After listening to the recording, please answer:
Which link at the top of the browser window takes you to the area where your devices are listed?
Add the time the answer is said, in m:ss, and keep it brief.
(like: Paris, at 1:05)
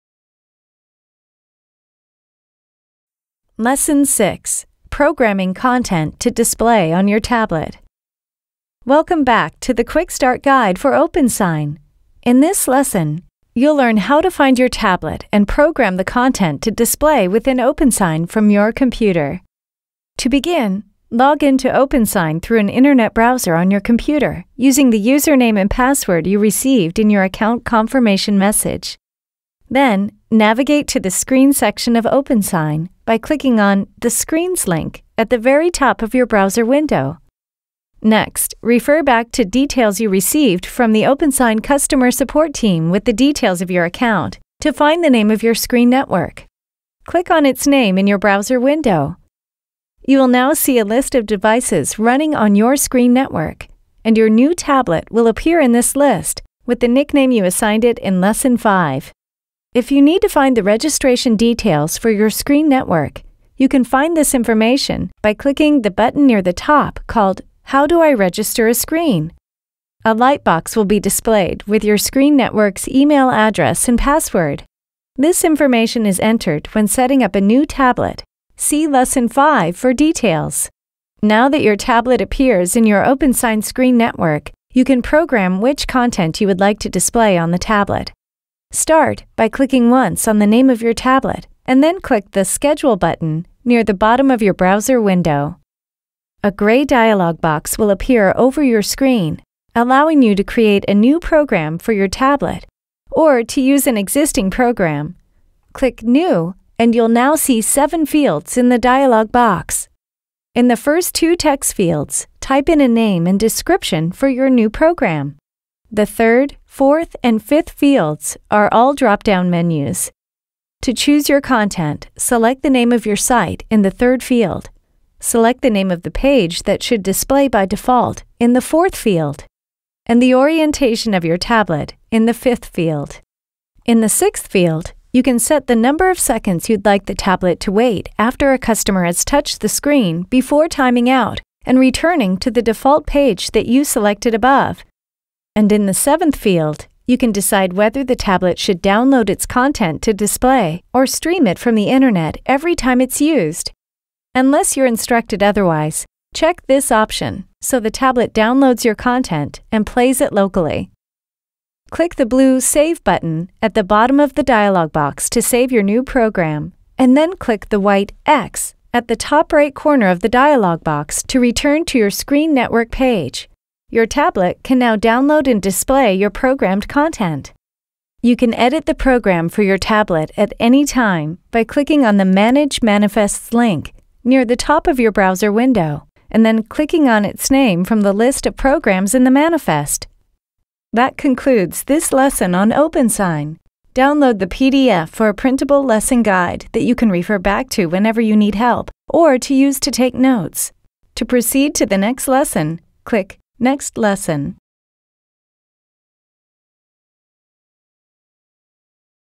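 Screens, at 0:33.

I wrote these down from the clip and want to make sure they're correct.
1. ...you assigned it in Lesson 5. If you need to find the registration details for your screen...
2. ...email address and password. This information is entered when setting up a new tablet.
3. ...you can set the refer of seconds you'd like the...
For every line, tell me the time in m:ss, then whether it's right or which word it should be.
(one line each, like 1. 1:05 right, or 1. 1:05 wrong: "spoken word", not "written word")
1. 0:57 right
2. 1:12 right
3. 2:15 wrong: "number", not "refer".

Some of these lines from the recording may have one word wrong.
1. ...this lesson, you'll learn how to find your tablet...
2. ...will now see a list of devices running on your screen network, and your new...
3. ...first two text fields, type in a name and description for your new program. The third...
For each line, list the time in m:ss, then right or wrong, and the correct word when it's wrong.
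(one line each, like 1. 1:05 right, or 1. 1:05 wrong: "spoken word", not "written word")
1. 0:12 right
2. 0:50 right
3. 1:50 right.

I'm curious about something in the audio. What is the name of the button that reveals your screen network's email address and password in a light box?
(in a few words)
How Do I Register a Screen?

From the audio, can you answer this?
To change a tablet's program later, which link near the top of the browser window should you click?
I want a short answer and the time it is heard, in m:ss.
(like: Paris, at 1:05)
Manage Manifests, at 3:02.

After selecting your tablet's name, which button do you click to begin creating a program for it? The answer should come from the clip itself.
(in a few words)
Schedule.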